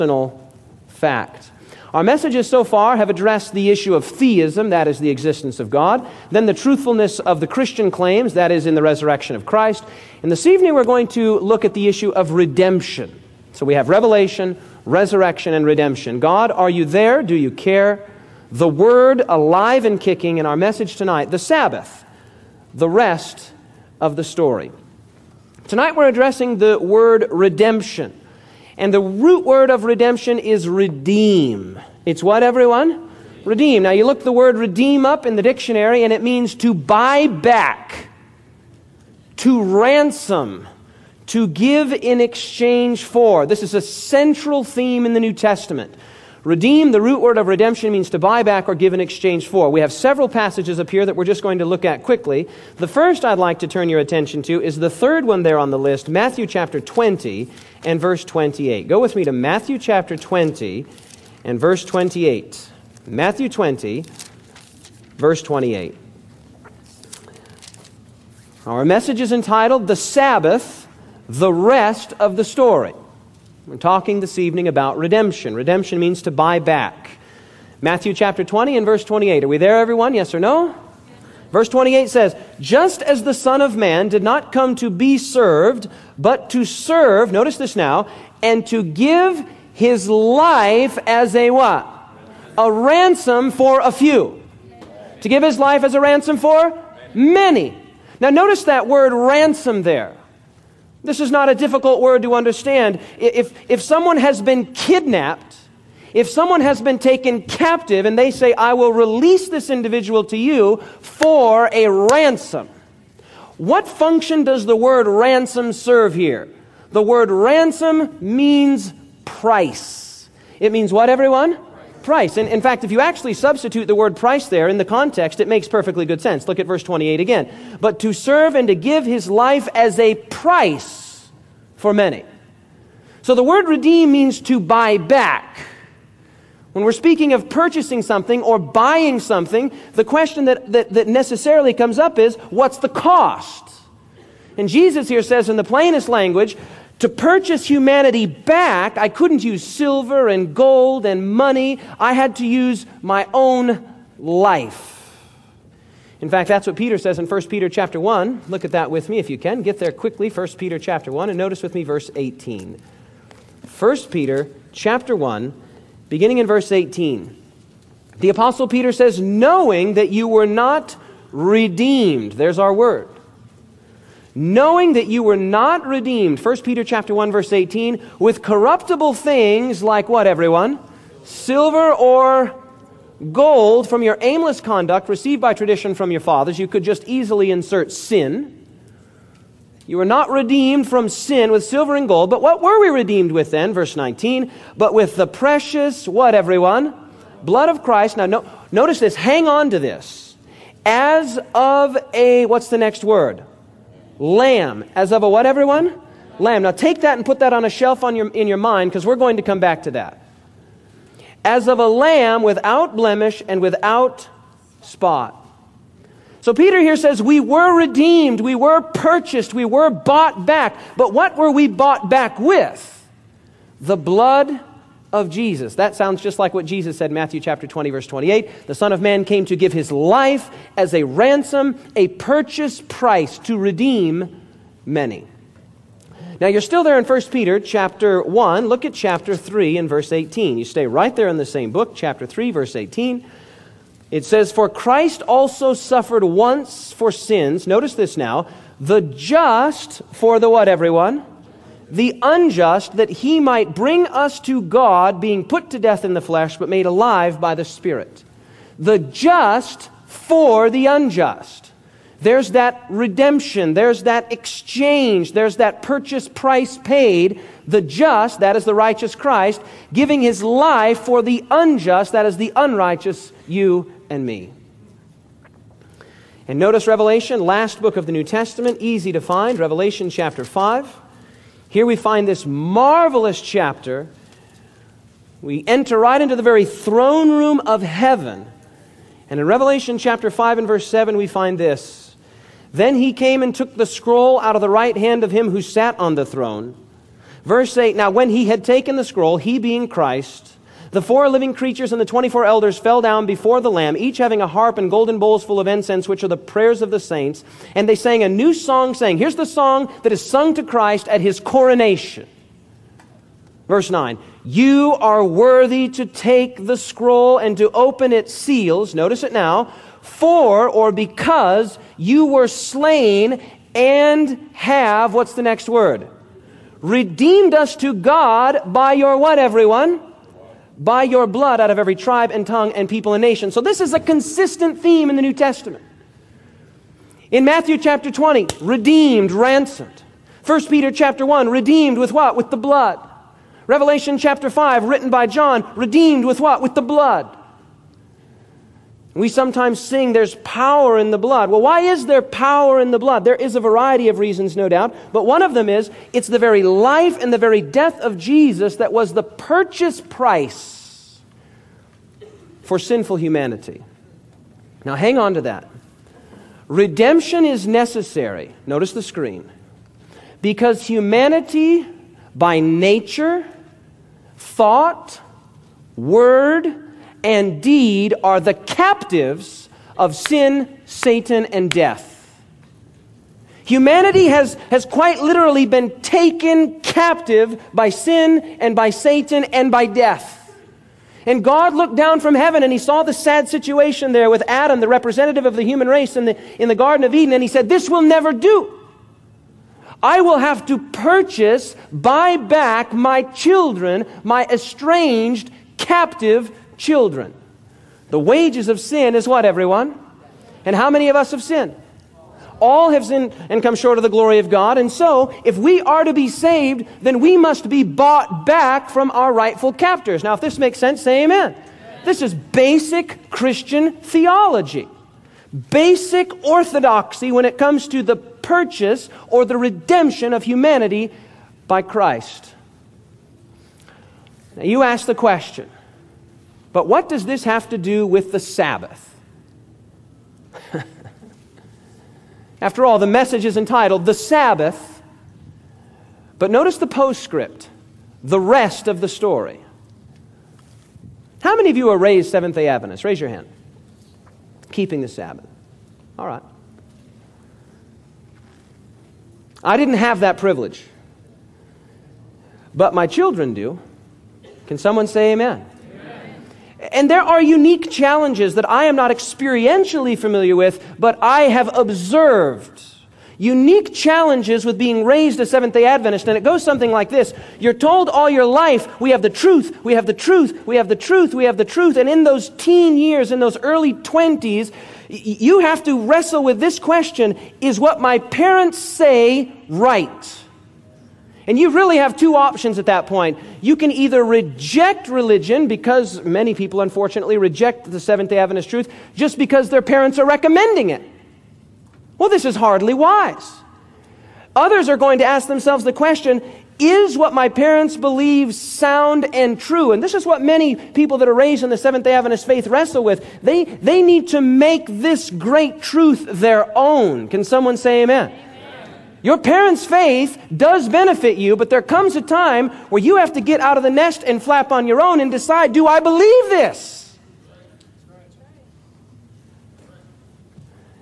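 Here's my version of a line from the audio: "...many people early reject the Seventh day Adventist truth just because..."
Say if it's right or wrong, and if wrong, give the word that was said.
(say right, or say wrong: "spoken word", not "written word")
wrong: "unfortunately", not "early".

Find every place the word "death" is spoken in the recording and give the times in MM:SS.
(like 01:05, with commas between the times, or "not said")
04:15, 05:57, 06:21, 06:29.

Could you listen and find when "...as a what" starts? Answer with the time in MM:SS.
01:31.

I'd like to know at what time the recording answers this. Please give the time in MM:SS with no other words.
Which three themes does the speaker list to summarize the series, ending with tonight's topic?
00:13.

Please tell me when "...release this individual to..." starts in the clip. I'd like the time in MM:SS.
01:48.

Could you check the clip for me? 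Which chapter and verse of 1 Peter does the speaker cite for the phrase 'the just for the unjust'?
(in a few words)
Chapter 3, verse 18.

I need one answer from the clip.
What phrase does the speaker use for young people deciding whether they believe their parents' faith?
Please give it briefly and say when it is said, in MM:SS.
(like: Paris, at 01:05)
get out of the nest, at 08:43.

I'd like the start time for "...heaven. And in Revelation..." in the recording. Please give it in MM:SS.
04:47.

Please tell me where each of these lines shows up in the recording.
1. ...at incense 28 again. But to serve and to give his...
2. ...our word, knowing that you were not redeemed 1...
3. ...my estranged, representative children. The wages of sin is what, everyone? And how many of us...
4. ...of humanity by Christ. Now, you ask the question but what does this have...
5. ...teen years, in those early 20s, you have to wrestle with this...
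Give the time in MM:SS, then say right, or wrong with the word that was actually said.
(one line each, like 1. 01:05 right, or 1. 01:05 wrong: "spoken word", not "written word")
1. 02:06 wrong: "verse", not "incense"
2. 02:52 right
3. 06:44 wrong: "captive", not "representative"
4. 07:10 right
5. 08:02 right.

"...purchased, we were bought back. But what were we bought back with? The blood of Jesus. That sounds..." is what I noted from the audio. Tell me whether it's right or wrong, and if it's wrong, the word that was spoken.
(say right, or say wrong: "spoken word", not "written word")
right.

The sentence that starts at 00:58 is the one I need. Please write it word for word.
Go with me to Matthew chapter 20 and verse 28.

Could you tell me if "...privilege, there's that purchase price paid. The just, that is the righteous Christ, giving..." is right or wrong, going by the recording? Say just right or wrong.
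wrong.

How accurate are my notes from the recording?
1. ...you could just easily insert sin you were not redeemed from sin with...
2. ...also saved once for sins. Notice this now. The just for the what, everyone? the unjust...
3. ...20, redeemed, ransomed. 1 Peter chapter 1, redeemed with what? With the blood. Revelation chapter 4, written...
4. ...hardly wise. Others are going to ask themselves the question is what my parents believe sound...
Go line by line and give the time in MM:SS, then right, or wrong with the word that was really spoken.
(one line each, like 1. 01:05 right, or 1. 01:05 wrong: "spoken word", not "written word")
1. 03:06 right
2. 04:05 wrong: "suffered", not "saved"
3. 05:38 wrong: "5", not "4"
4. 08:22 right.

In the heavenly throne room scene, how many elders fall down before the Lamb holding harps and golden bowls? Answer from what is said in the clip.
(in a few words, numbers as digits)
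24.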